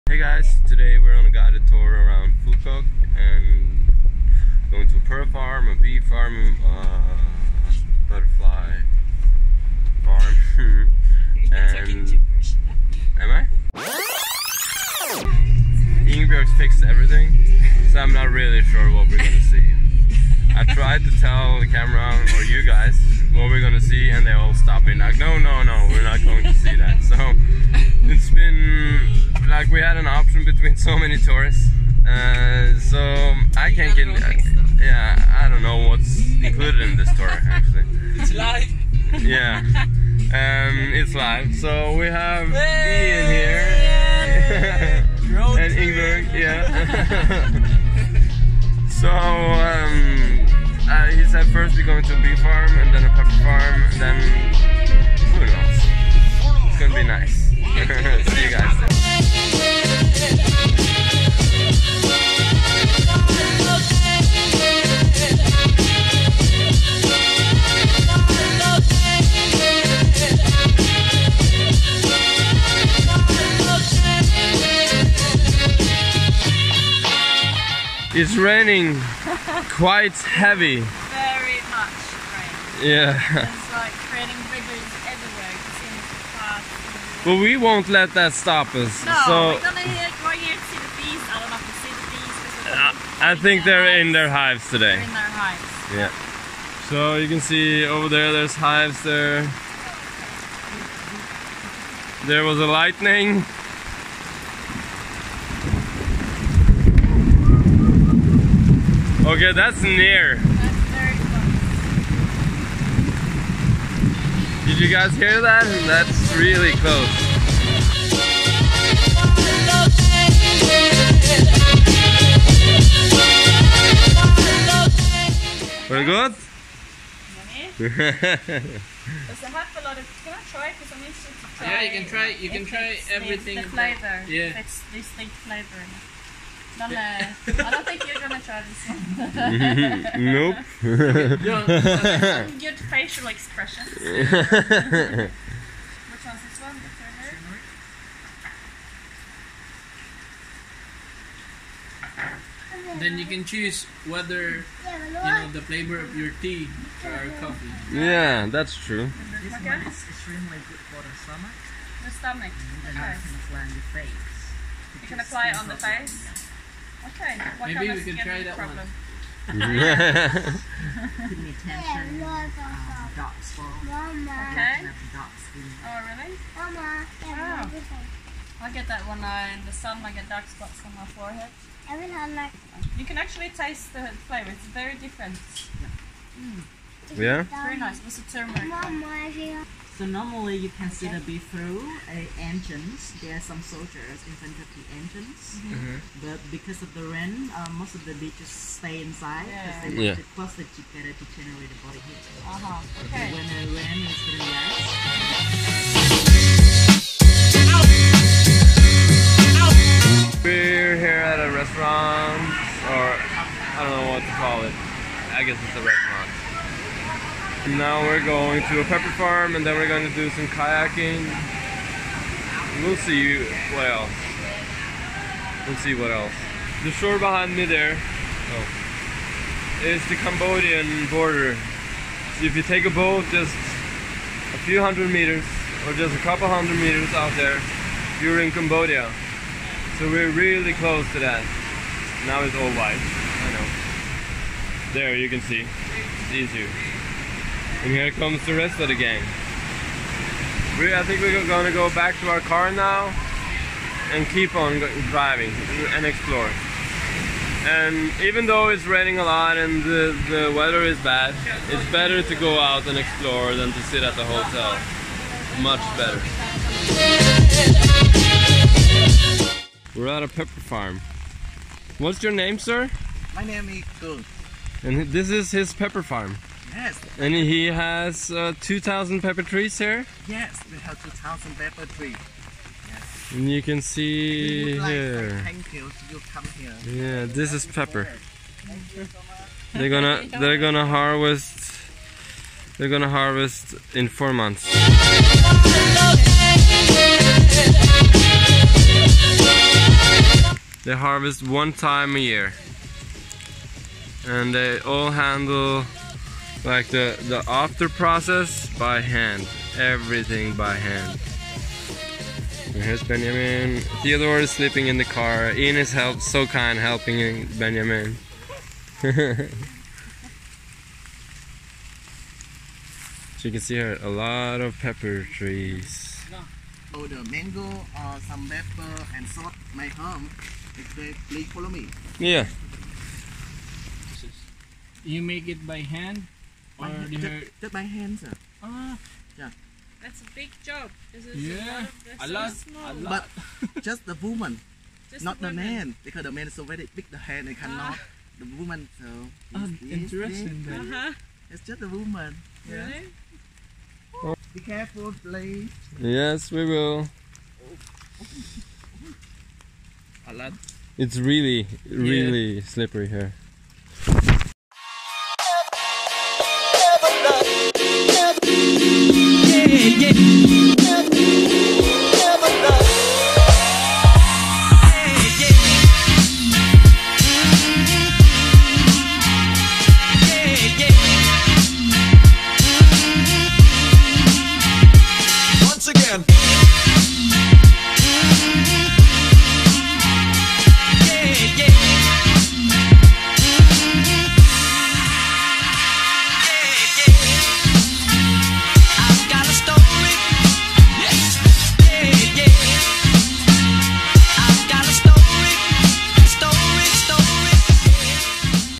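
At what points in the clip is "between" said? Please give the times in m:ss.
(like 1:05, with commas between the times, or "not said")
0:30.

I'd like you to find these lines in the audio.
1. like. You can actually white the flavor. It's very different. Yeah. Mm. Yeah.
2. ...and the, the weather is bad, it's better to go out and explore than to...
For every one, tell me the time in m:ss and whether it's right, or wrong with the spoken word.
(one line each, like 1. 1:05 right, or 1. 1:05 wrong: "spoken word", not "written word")
1. 3:01 wrong: "taste", not "white"
2. 4:19 right.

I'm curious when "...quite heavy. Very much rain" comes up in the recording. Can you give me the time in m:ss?
1:19.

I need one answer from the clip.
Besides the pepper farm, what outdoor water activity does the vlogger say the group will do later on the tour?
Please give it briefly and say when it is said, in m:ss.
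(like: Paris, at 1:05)
kayaking, at 3:40.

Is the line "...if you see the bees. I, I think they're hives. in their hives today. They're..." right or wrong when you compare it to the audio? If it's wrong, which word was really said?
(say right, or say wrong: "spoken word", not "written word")
right.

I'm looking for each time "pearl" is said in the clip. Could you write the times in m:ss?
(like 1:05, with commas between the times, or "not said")
0:05.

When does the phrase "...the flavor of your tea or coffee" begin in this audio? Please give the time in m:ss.
2:35.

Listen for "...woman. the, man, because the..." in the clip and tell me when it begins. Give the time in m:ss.
5:45.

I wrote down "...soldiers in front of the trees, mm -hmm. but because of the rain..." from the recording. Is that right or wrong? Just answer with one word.
wrong.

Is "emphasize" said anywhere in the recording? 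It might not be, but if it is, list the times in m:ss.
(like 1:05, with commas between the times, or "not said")
not said.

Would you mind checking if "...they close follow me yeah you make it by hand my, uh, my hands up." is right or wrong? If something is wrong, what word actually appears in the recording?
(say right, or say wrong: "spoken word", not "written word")
wrong: "please", not "close".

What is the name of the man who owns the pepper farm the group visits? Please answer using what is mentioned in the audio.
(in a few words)
Kung.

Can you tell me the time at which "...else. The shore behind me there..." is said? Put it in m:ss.
3:46.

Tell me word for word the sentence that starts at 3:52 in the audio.
So if you take a boat just a few hundred meters or just a couple hundred meters out there, you're in Cambodia.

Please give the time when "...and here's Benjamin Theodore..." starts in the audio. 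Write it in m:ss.
5:12.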